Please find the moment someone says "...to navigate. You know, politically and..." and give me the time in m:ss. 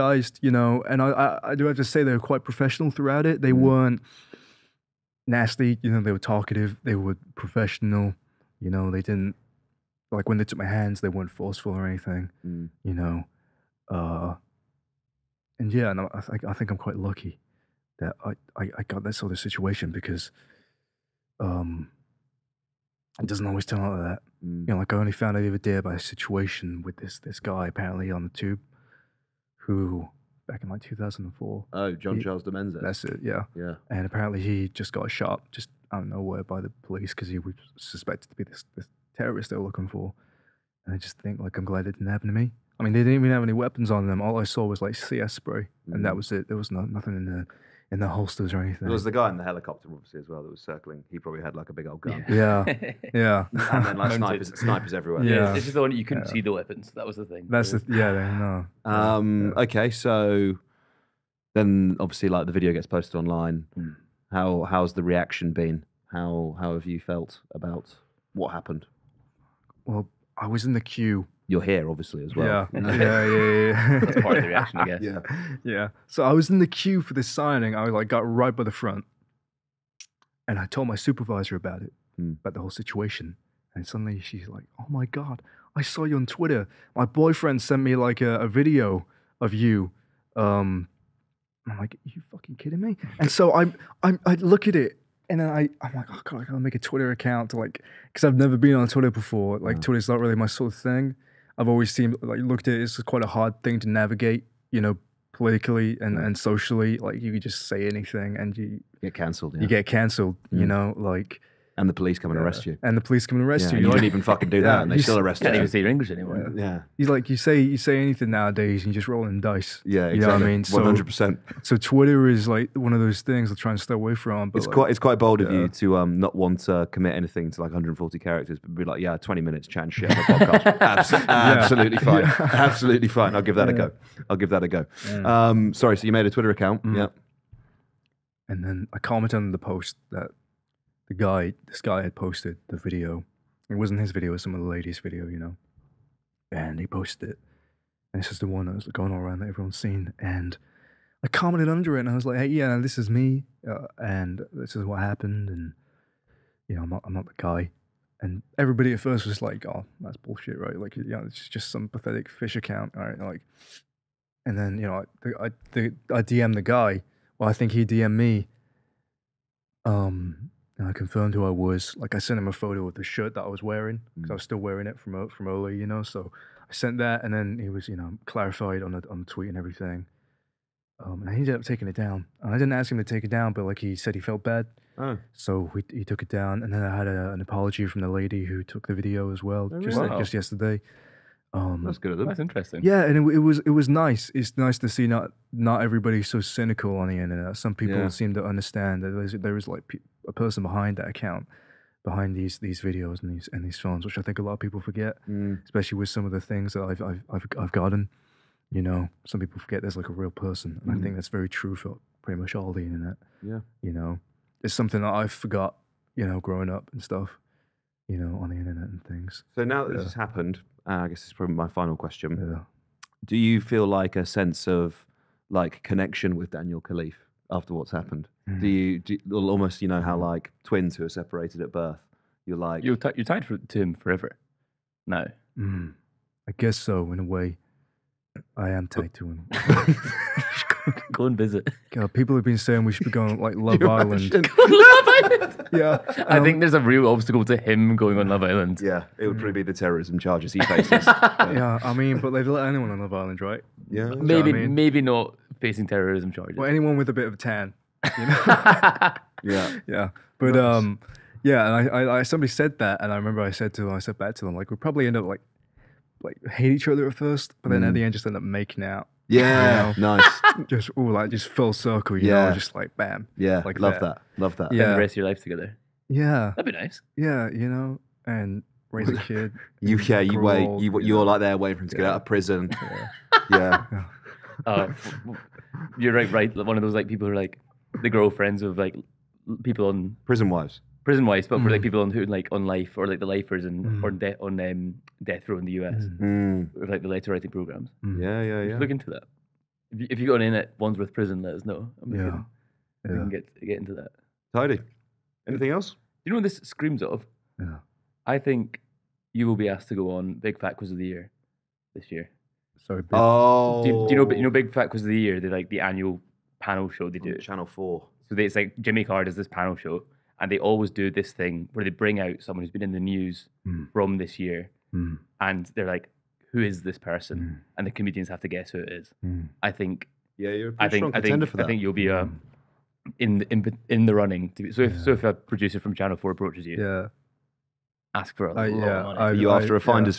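1:43.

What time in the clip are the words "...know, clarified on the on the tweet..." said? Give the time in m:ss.
2:57.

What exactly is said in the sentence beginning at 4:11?
yeah, I mean, but they'd let anyone on Love Island, right?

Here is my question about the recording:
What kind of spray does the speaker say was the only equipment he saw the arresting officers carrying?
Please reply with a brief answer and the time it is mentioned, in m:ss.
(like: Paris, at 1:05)
CS spray, at 0:44.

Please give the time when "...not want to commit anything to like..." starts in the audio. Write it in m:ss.
2:06.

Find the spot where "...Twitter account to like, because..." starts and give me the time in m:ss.
1:36.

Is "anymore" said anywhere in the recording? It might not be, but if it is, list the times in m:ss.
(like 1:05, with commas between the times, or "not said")
1:56.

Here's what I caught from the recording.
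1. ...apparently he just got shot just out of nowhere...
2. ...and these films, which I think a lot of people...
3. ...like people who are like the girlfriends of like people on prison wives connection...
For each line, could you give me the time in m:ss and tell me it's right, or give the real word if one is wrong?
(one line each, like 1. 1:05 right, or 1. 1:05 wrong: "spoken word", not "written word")
1. 0:34 right
2. 3:23 right
3. 4:46 wrong: "prison", not "connection".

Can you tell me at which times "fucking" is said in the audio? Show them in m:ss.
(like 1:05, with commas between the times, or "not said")
1:32, 1:54.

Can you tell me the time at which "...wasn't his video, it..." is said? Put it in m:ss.
2:23.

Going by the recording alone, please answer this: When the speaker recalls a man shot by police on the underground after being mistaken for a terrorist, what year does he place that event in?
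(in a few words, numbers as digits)
2004.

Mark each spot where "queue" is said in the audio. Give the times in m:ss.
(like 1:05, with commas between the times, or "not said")
1:10, 1:16.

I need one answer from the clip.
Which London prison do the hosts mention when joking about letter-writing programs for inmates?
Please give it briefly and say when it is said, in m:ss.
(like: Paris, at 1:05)
Wandsworth Prison, at 5:00.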